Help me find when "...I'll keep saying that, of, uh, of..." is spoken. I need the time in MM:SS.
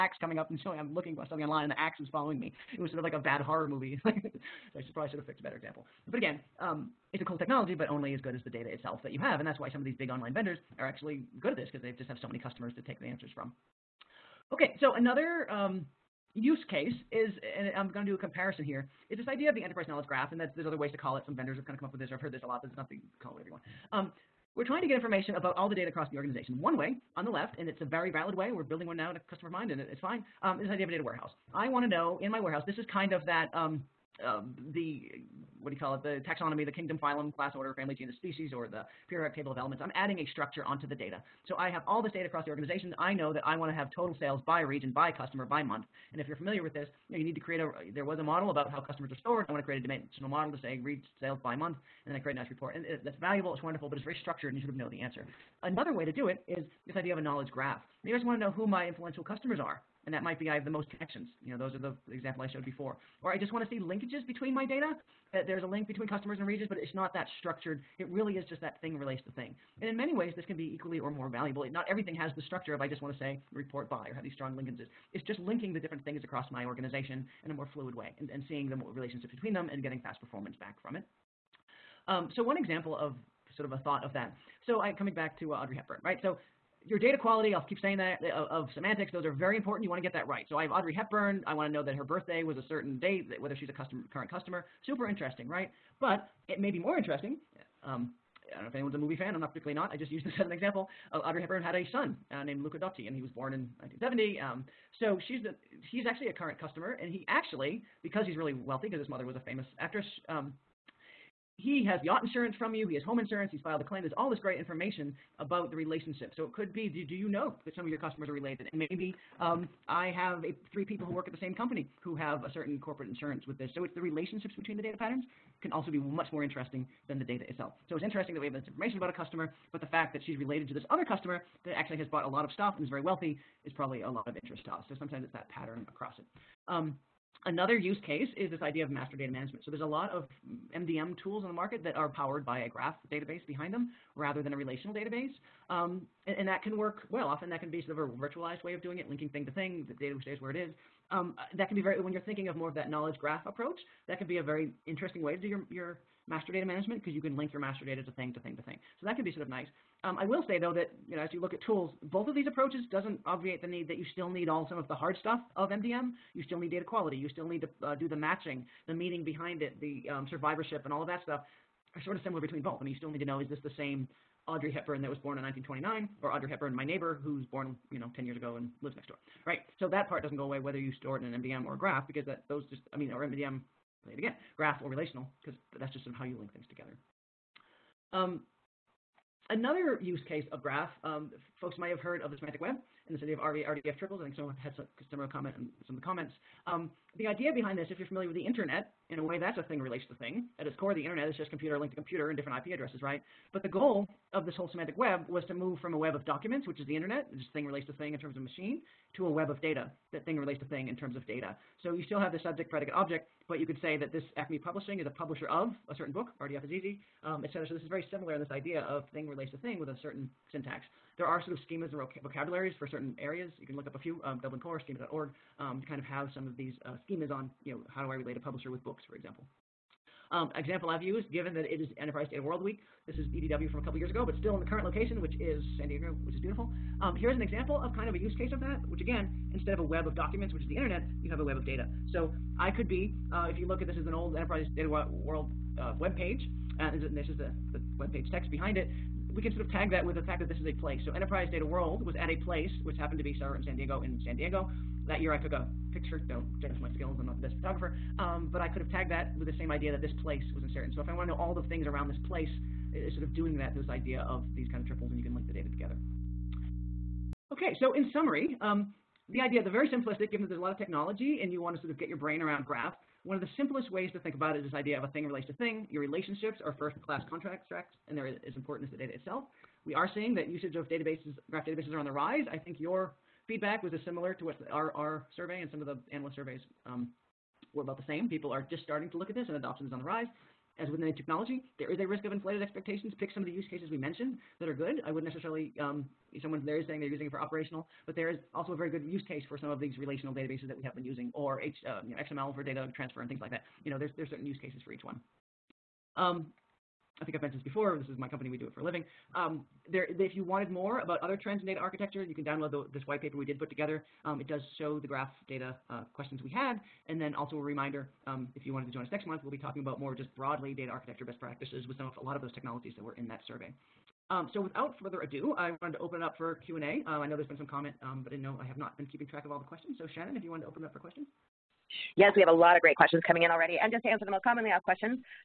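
01:27.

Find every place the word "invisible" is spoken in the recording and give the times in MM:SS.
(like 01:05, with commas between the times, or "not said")
not said.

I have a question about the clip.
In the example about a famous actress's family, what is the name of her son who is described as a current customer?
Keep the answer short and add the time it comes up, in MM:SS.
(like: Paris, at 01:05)
Luca Dotti, at 01:42.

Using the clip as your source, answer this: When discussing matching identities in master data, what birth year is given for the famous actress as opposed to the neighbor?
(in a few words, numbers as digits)
1929.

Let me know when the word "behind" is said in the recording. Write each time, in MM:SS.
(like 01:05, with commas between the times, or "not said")
02:23, 02:49, 03:17, 04:08.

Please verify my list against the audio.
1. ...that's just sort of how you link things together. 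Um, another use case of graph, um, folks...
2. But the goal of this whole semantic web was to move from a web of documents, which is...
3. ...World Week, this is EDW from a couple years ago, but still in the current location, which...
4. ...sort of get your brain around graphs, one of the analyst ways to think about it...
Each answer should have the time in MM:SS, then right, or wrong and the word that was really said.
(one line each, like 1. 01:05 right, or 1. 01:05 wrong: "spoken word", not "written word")
1. 03:05 right
2. 03:23 right
3. 03:52 right
4. 04:31 wrong: "simplest", not "analyst".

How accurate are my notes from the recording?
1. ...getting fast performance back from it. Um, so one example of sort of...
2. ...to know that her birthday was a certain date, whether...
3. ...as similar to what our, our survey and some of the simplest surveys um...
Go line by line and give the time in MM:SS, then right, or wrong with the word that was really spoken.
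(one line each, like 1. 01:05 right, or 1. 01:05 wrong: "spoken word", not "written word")
1. 01:19 right
2. 01:31 right
3. 04:43 wrong: "analyst", not "simplest".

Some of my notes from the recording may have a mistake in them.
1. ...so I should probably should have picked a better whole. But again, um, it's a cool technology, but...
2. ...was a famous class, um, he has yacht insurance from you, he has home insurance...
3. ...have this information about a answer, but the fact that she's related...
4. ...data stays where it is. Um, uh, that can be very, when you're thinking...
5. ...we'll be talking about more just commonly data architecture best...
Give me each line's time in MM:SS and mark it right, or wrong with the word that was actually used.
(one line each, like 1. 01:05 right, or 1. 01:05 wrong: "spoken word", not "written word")
1. 00:04 wrong: "example", not "whole"
2. 01:49 wrong: "actress", not "class"
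3. 02:08 wrong: "customer", not "answer"
4. 02:30 right
5. 05:19 wrong: "broadly", not "commonly".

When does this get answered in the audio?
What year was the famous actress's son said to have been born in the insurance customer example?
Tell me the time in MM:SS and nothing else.
01:43.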